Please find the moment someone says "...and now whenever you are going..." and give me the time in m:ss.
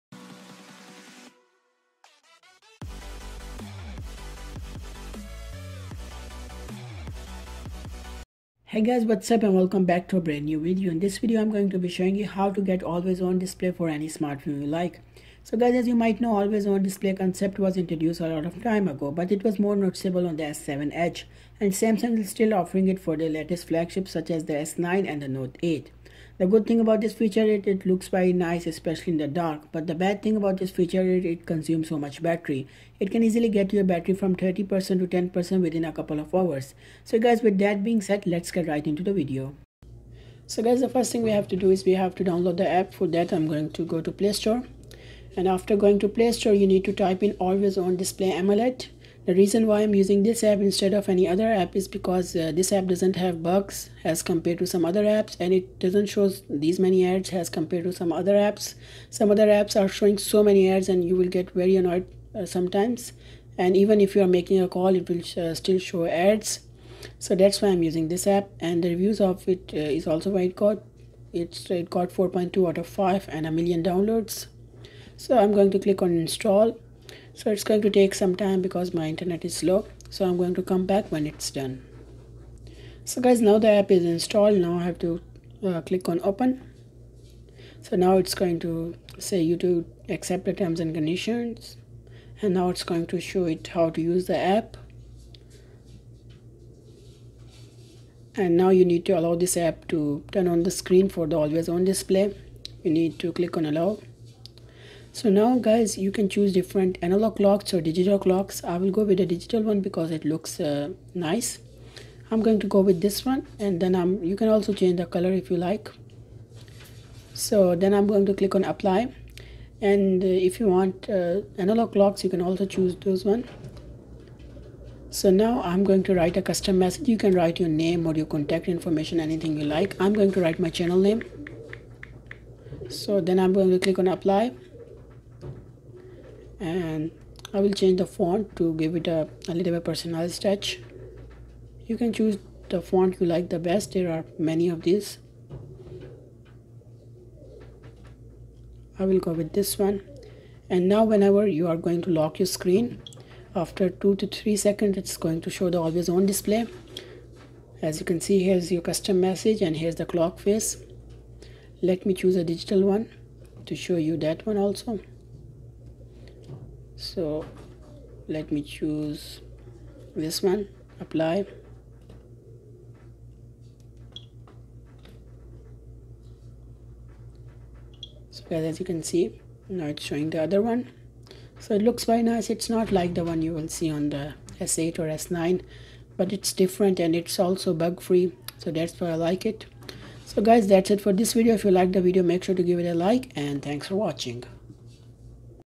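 2:30.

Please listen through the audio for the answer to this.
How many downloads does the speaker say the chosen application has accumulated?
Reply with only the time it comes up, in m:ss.
1:13.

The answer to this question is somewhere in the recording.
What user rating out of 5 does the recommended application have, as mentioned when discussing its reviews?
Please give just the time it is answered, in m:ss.
1:12.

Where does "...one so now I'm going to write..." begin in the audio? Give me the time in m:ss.
2:03.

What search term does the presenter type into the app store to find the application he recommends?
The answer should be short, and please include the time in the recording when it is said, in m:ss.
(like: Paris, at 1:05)
always on display AMOLED, at 0:47.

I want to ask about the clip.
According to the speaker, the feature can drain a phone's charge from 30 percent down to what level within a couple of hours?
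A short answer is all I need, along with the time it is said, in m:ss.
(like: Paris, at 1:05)
10%, at 0:35.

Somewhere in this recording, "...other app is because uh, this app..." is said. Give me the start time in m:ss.
0:51.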